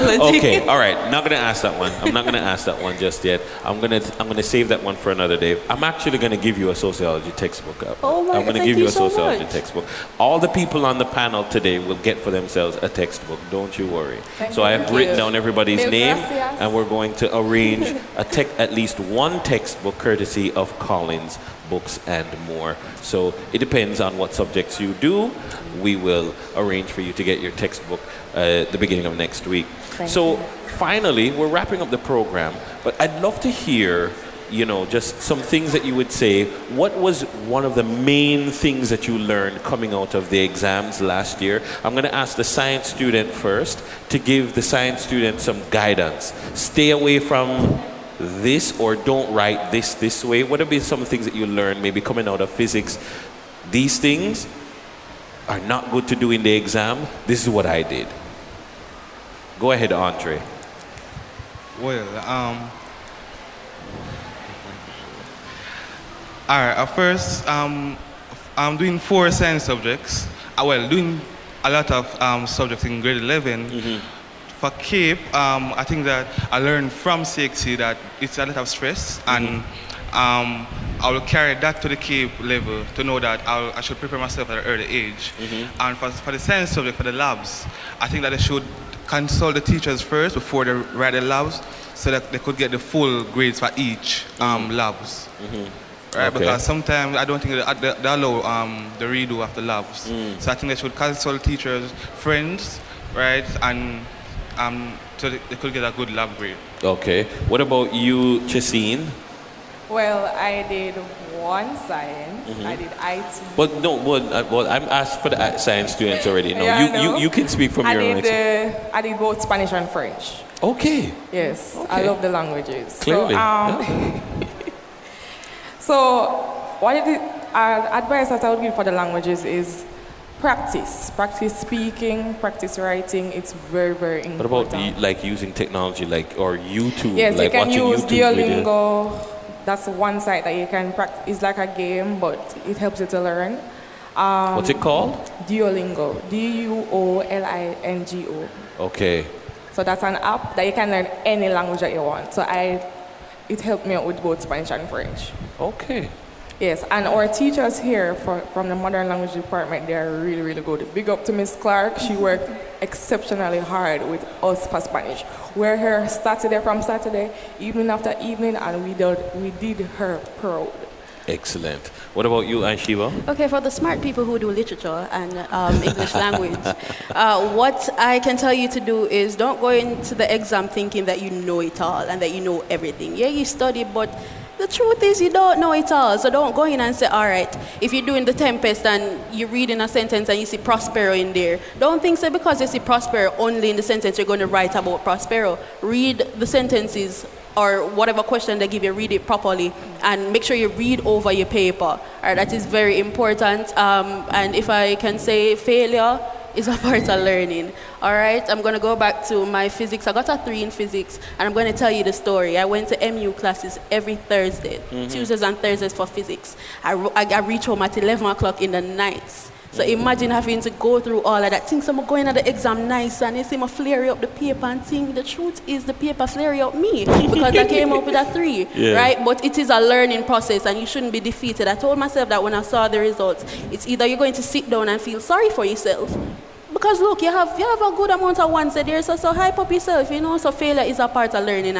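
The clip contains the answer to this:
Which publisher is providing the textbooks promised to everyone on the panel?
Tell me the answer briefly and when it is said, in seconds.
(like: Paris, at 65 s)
Collins, at 20 s.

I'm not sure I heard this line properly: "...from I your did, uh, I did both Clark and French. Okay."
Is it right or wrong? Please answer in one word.
wrong.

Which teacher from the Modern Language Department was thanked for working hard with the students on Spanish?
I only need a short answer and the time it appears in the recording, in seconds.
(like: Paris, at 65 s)
Miss Clark, at 161 s.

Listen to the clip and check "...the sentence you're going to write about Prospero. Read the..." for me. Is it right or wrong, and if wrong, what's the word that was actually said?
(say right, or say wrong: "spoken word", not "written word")
right.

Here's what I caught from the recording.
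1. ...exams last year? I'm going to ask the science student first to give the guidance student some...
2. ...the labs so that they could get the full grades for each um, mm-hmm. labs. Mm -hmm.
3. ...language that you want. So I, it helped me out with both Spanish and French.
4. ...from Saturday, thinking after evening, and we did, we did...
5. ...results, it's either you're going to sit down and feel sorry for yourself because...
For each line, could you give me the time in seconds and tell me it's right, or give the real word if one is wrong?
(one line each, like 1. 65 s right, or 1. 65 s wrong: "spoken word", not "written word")
1. 40 s wrong: "science", not "guidance"
2. 91 s right
3. 151 s right
4. 166 s wrong: "evening", not "thinking"
5. 232 s right.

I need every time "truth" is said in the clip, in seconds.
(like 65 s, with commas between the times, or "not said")
184 s, 225 s.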